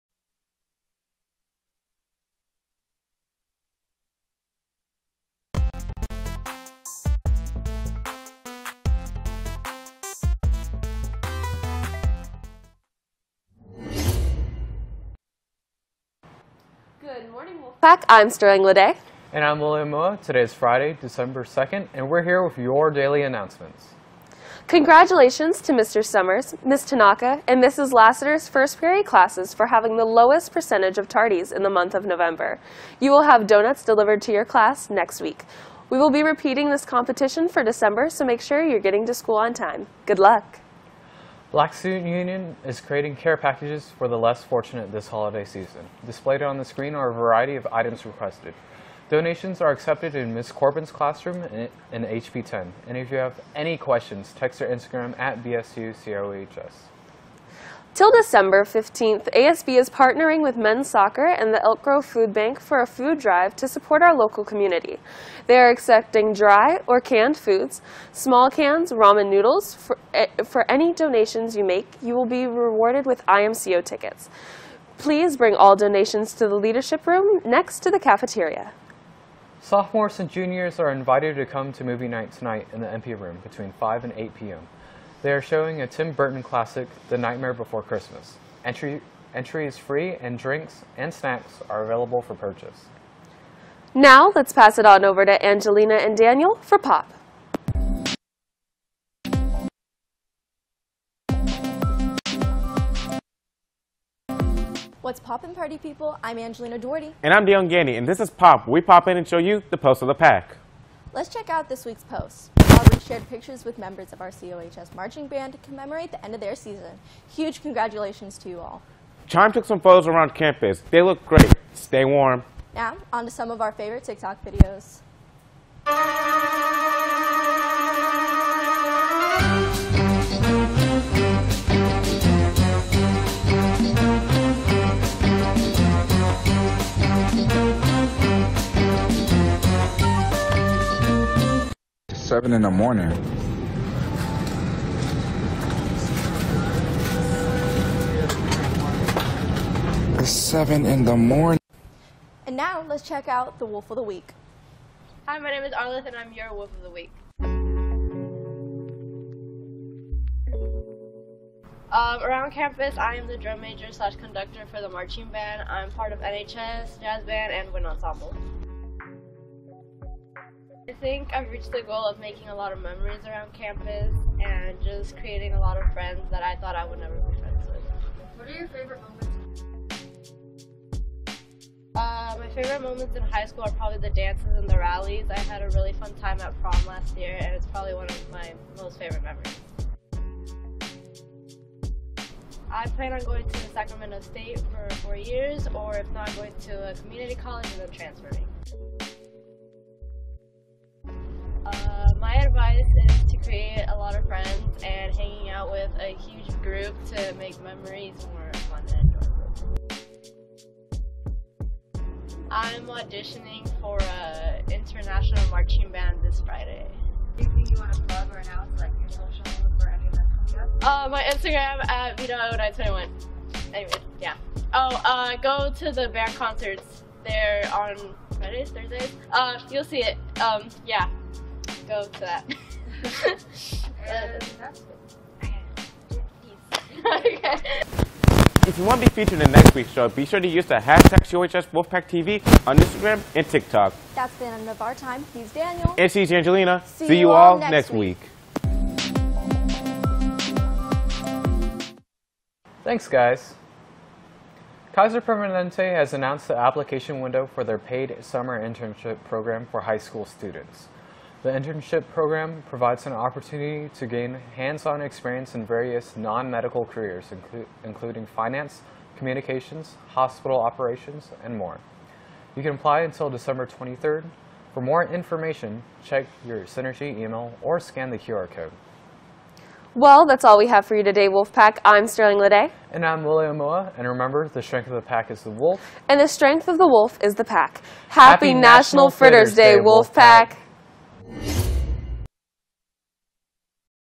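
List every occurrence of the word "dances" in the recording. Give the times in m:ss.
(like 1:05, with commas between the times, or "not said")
3:04.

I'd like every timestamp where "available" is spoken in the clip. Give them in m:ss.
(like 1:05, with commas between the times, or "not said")
1:31.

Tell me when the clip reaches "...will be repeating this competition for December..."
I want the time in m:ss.
0:35.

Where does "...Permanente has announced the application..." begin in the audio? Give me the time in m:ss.
4:15.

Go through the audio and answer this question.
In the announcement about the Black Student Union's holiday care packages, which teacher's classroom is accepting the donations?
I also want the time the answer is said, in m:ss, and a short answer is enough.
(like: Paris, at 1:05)
Ms. Corbin, at 0:50.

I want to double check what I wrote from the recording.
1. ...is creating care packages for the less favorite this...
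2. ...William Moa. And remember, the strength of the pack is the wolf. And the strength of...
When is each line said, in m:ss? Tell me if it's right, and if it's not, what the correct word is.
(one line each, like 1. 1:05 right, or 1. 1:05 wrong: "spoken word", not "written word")
1. 0:42 wrong: "fortunate", not "favorite"
2. 4:43 right.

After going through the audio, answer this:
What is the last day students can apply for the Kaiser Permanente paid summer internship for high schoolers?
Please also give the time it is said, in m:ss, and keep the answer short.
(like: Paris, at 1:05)
December 23rd, at 4:33.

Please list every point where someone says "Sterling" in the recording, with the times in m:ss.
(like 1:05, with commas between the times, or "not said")
0:18, 4:42.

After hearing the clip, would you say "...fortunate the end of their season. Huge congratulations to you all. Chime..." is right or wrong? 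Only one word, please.
wrong.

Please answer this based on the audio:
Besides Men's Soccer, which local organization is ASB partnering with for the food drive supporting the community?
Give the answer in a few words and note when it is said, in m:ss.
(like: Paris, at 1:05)
Elk Grove Food Bank, at 1:01.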